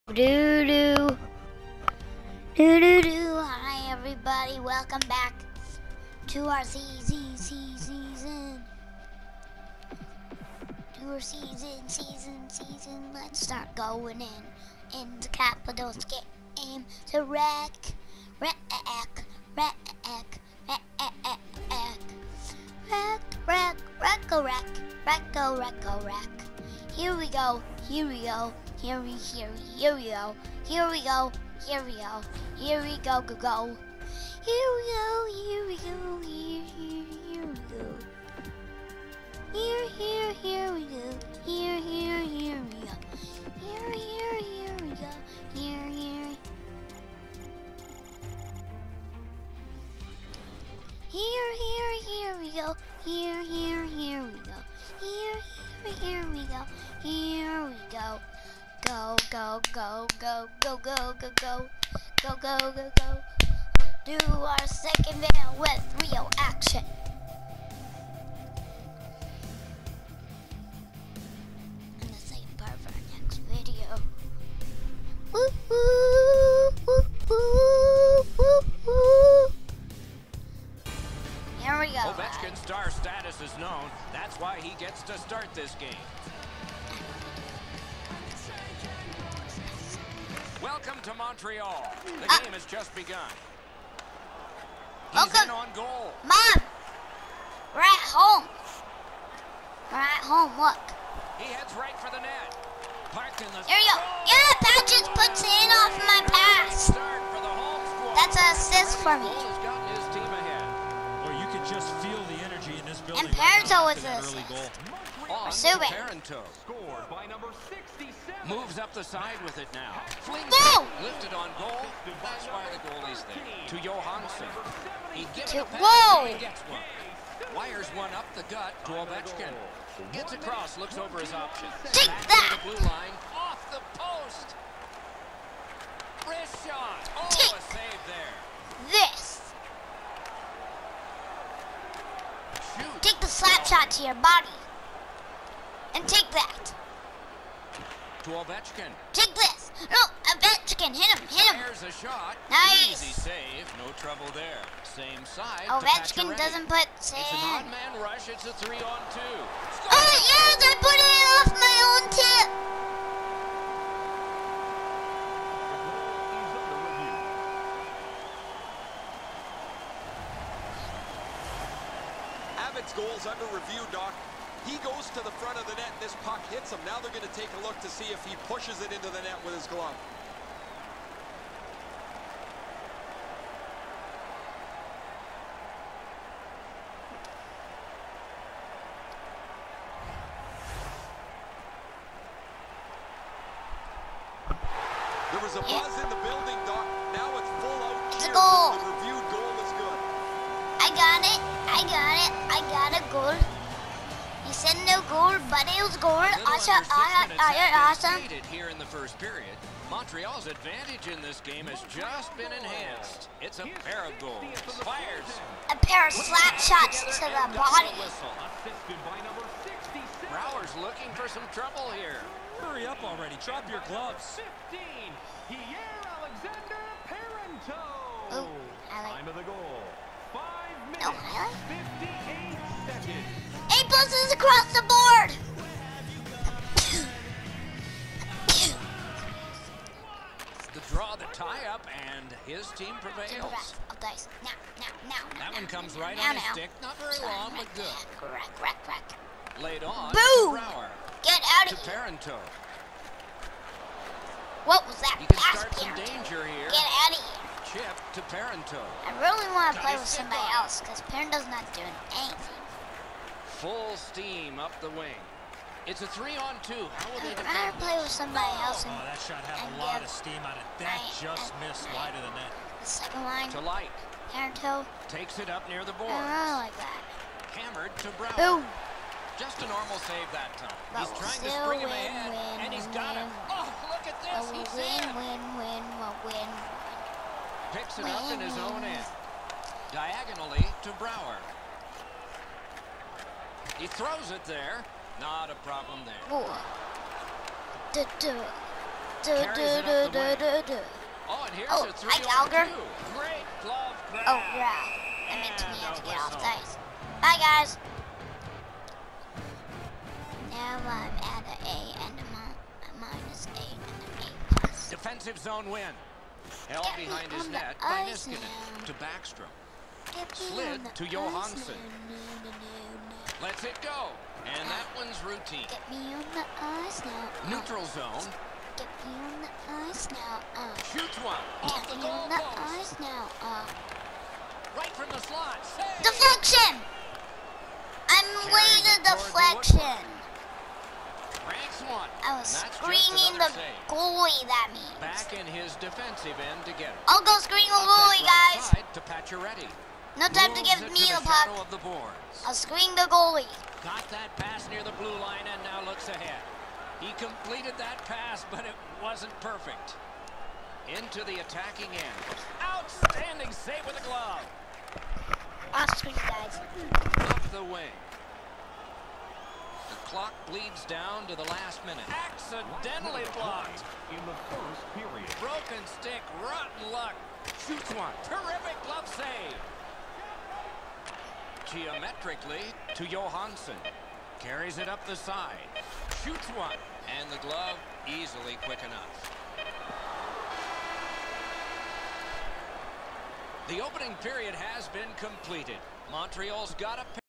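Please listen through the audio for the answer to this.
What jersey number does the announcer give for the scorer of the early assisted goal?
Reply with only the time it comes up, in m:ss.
1:57.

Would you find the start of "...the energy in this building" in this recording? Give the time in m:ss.
1:52.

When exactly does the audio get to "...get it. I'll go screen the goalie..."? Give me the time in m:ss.
5:46.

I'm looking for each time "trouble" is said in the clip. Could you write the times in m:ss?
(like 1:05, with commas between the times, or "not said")
2:33, 3:41.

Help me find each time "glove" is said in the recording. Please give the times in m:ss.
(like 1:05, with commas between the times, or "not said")
2:59, 3:43, 5:03, 6:04, 6:18, 6:27.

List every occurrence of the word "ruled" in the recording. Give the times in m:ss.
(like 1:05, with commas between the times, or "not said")
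not said.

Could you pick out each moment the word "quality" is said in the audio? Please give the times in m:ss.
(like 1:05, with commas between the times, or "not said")
not said.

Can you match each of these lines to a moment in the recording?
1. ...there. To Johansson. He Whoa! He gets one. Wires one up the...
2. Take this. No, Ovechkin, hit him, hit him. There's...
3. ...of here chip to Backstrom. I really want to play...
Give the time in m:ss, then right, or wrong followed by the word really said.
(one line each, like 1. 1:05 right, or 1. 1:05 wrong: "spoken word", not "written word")
1. 2:03 right
2. 2:29 right
3. 4:17 wrong: "Parenteau", not "Backstrom".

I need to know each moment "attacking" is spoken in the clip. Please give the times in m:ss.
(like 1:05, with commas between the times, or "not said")
6:01.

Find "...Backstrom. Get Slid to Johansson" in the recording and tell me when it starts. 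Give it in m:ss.
5:18.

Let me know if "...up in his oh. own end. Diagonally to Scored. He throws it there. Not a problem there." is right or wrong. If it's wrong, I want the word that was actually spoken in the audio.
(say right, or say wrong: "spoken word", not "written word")
wrong: "Brouwer", not "Scored".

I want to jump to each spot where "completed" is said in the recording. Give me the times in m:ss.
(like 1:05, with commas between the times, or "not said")
5:57, 6:35.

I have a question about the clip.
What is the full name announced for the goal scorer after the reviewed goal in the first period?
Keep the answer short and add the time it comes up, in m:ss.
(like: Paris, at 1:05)
Pierre Alexander Parenteau, at 3:45.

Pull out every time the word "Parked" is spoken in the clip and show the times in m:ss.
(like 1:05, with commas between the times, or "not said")
1:43.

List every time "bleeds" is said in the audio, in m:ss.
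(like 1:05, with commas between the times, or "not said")
6:10.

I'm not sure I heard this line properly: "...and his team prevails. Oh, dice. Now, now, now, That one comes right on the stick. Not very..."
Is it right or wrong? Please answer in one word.
right.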